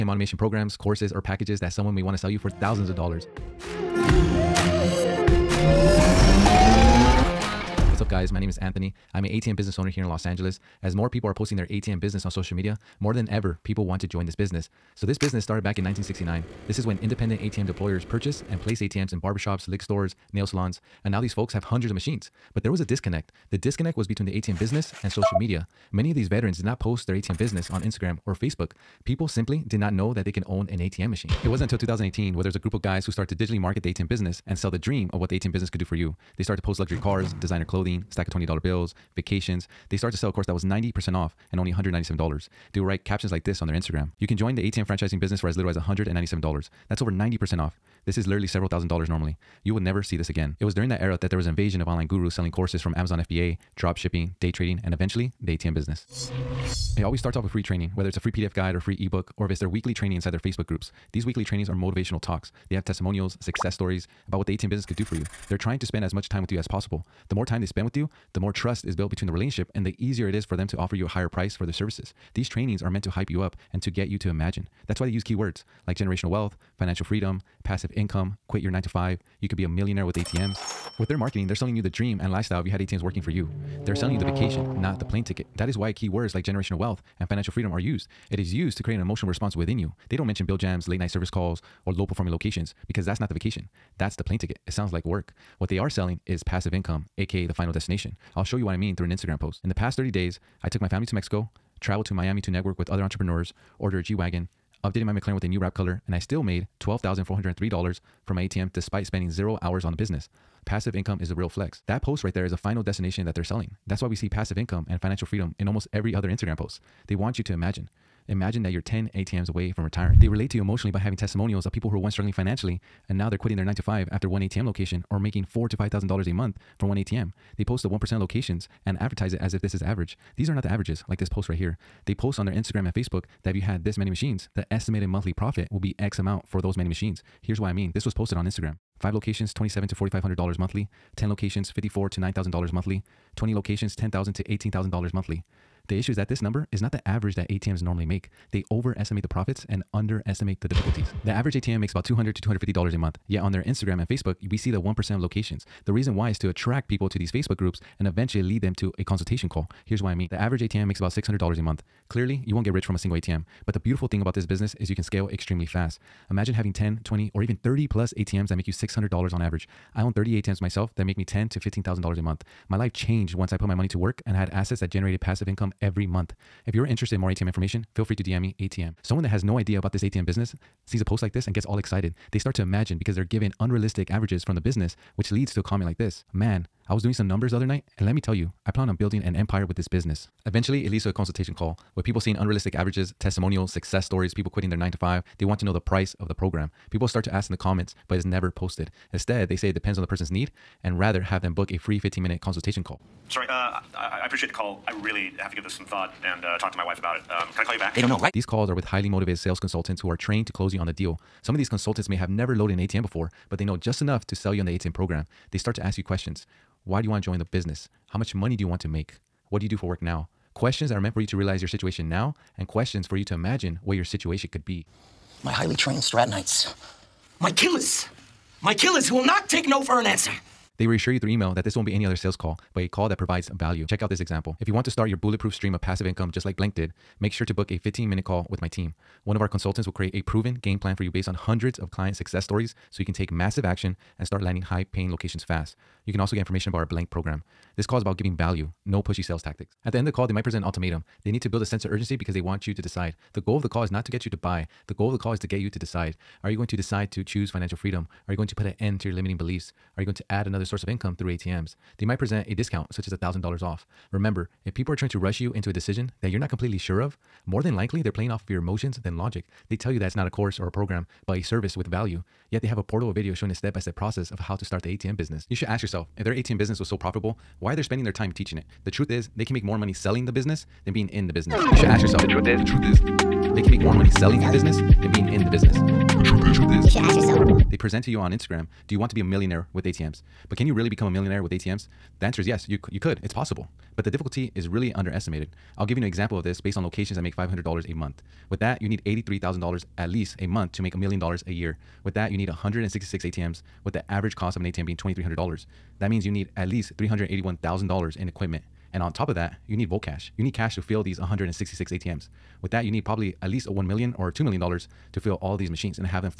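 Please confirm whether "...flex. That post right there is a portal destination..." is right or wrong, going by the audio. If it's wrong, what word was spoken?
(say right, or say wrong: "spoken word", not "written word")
wrong: "final", not "portal".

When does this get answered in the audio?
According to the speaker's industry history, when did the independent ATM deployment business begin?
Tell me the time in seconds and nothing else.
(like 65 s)
15 s.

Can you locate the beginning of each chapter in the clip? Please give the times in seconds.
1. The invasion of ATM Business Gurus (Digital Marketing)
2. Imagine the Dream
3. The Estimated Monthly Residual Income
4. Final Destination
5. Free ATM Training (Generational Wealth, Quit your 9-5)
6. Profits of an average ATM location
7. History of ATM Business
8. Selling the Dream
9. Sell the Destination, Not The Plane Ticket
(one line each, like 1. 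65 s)
1. 31 s
2. 117 s
3. 131 s
4. 110 s
5. 56 s
6. 151 s
7. 8 s
8. 80 s
9. 99 s.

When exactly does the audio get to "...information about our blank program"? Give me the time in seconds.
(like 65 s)
246 s.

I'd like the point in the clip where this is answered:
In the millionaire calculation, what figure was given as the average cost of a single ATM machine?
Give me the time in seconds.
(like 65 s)
304 s.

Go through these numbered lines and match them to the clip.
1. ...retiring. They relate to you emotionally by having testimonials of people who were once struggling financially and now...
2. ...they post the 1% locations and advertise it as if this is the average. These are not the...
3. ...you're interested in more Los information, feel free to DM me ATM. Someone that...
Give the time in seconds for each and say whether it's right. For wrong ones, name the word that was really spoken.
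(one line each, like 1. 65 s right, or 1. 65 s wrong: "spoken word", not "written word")
1. 119 s right
2. 127 s right
3. 176 s wrong: "ATM", not "Los".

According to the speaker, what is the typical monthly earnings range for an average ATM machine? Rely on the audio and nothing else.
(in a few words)
$200 to $250.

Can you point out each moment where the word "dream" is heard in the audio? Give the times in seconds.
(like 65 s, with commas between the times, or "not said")
34 s, 81 s.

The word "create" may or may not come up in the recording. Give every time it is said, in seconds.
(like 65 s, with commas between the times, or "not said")
88 s, 239 s.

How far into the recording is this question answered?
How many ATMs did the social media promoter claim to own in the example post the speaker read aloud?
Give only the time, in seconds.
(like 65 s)
170 s.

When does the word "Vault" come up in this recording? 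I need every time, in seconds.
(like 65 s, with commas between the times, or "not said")
309 s.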